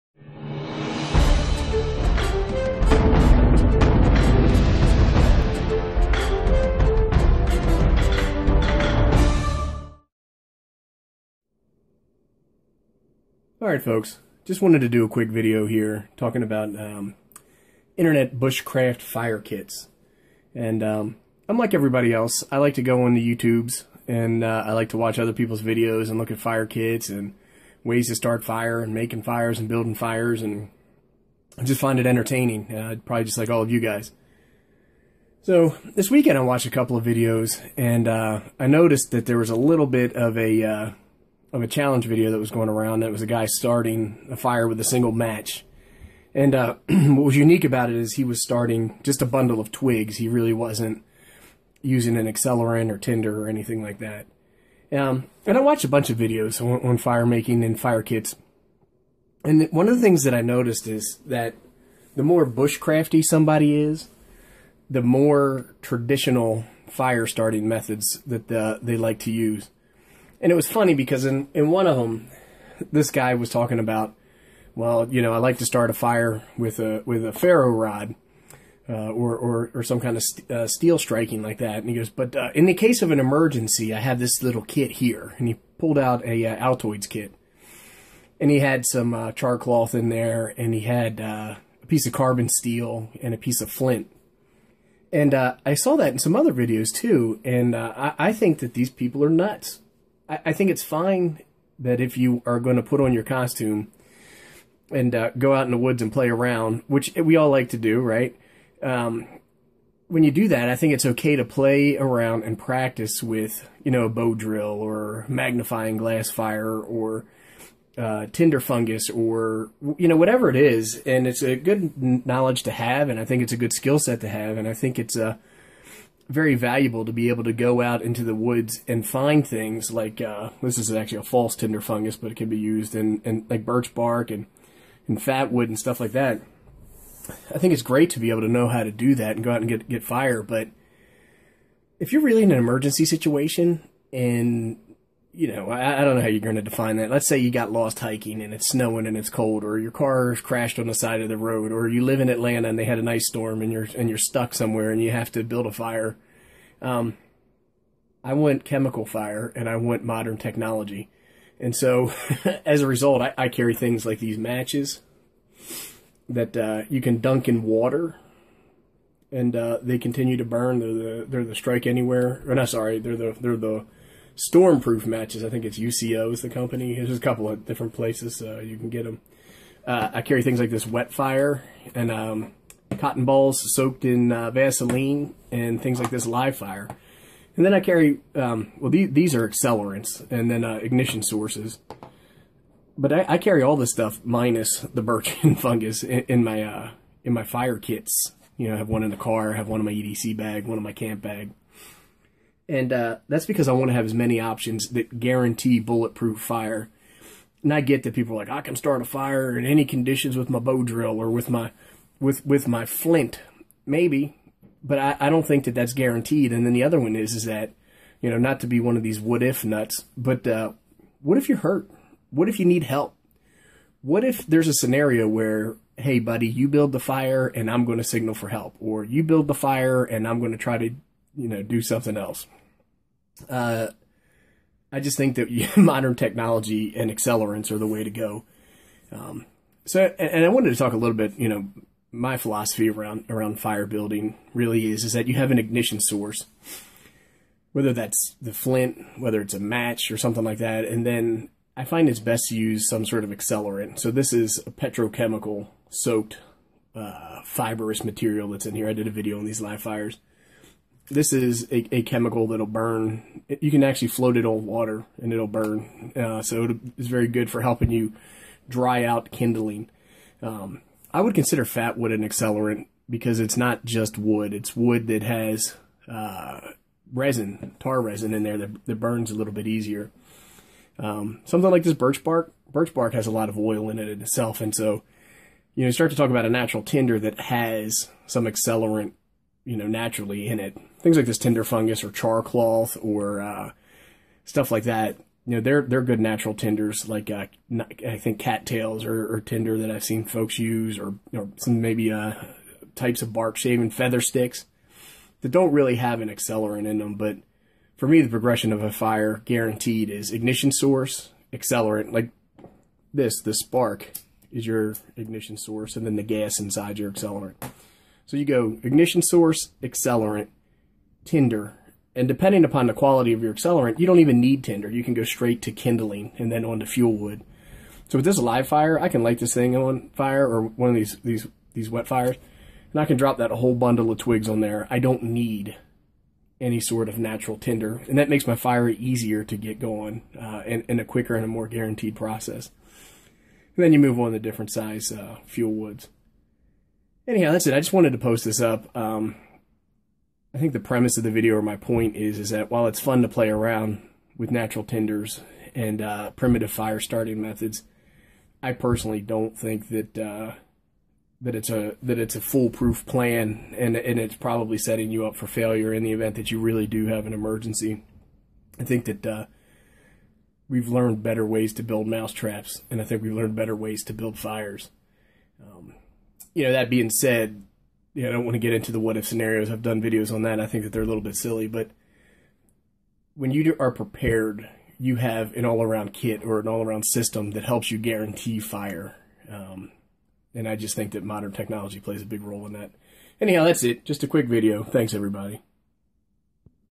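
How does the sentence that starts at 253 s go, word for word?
So this is a petrochemical soaked uh, fibrous material that's in here.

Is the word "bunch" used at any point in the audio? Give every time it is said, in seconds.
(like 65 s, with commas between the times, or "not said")
55 s.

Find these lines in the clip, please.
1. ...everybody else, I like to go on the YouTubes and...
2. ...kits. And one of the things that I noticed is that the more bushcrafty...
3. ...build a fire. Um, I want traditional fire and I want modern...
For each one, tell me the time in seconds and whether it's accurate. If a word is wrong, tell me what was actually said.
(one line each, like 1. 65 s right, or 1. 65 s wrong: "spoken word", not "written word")
1. 21 s right
2. 58 s right
3. 155 s wrong: "chemical", not "traditional".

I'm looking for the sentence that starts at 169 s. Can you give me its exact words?
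And uh, they continue to burn.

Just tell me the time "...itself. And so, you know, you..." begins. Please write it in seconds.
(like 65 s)
284 s.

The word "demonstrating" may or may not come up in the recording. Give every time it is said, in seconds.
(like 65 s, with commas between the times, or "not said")
not said.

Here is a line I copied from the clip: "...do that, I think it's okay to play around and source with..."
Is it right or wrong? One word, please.
wrong.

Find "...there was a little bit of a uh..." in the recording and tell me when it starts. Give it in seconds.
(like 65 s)
39 s.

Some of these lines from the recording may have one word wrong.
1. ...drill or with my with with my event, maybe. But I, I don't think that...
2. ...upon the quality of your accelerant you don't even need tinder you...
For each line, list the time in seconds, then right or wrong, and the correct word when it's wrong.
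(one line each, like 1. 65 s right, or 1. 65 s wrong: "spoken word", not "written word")
1. 210 s wrong: "flint", not "event"
2. 322 s right.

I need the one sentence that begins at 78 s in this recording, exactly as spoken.
Uh, or, or, or some kind of st uh, steel striking like that.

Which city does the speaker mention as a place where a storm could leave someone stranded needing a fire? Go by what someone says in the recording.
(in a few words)
Atlanta.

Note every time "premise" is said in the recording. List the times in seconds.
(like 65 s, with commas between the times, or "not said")
350 s.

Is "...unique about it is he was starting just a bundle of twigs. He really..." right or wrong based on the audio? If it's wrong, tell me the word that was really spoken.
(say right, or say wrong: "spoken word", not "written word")
right.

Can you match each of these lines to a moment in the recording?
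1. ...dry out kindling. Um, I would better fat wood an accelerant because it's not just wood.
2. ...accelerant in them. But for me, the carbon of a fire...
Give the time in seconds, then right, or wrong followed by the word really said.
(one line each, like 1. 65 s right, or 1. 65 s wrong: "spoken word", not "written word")
1. 268 s wrong: "consider", not "better"
2. 306 s wrong: "progression", not "carbon".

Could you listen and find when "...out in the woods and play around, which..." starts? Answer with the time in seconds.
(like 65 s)
105 s.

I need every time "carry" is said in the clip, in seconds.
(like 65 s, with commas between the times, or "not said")
163 s, 180 s, 187 s, 193 s.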